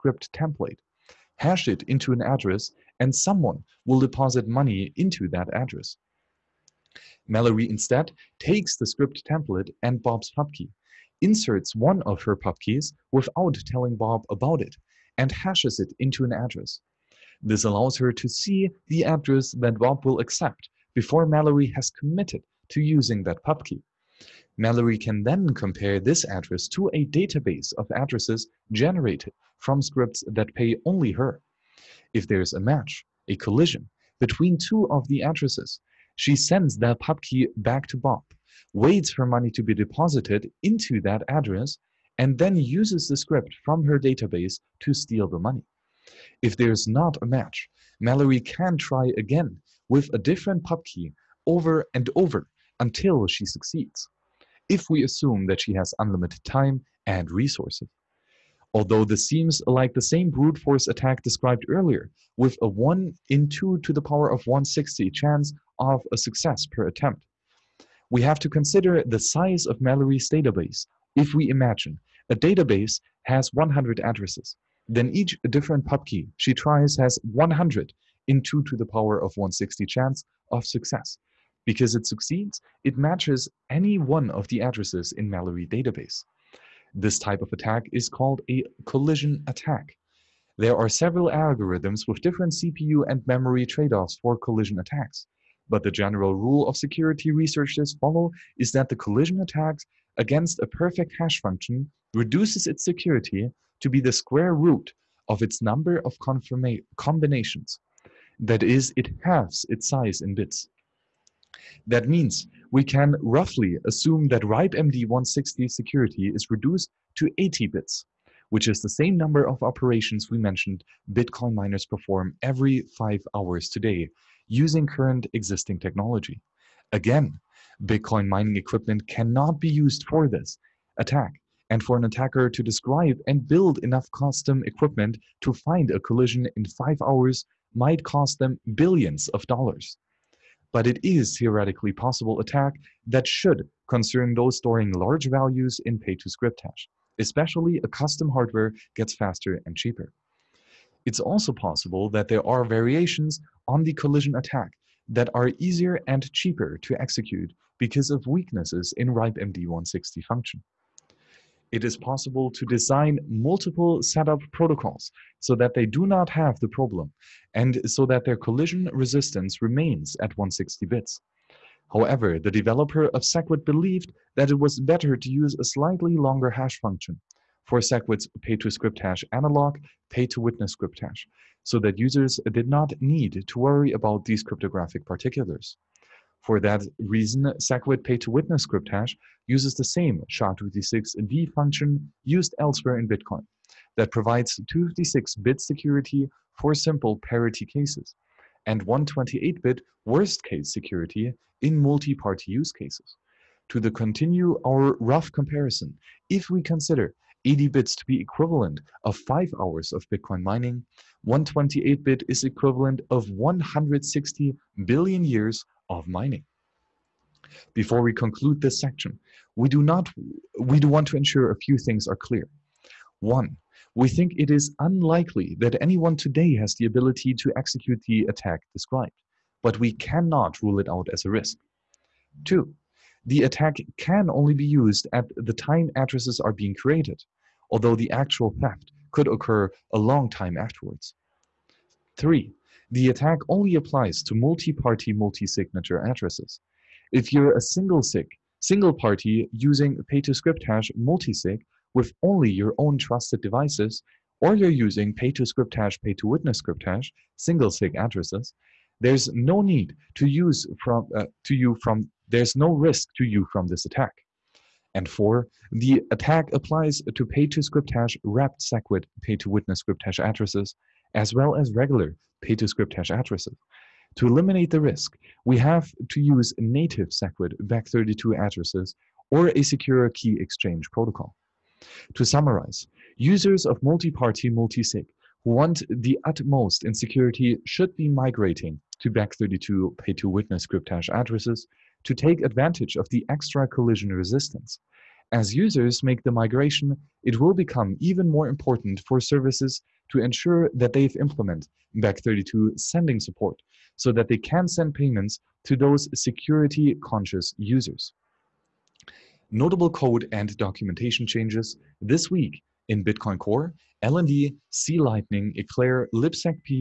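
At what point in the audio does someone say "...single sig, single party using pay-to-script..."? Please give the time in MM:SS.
04:07.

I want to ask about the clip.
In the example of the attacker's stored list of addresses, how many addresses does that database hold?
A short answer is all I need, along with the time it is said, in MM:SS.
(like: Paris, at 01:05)
100, at 01:13.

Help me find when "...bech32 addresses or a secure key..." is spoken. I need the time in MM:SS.
04:37.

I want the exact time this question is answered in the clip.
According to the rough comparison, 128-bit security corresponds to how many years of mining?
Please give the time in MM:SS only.
03:33.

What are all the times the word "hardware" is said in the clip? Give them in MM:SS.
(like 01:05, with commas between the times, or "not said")
02:28.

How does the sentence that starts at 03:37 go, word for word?
Before we conclude this section, we do not we do want to ensure a few things are clear.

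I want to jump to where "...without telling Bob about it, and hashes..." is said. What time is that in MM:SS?
00:13.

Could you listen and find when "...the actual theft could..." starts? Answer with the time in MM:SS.
03:57.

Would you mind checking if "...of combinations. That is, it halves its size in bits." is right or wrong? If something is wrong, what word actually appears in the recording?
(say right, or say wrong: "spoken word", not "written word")
right.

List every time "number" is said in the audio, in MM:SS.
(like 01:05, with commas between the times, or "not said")
01:45, 01:59.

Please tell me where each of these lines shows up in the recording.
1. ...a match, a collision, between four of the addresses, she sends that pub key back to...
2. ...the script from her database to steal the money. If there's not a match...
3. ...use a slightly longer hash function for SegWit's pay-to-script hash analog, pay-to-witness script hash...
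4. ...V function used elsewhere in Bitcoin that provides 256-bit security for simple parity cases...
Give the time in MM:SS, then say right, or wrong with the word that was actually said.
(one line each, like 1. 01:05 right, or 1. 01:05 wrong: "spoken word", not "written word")
1. 00:32 wrong: "two", not "four"
2. 00:43 right
3. 02:55 right
4. 03:11 right.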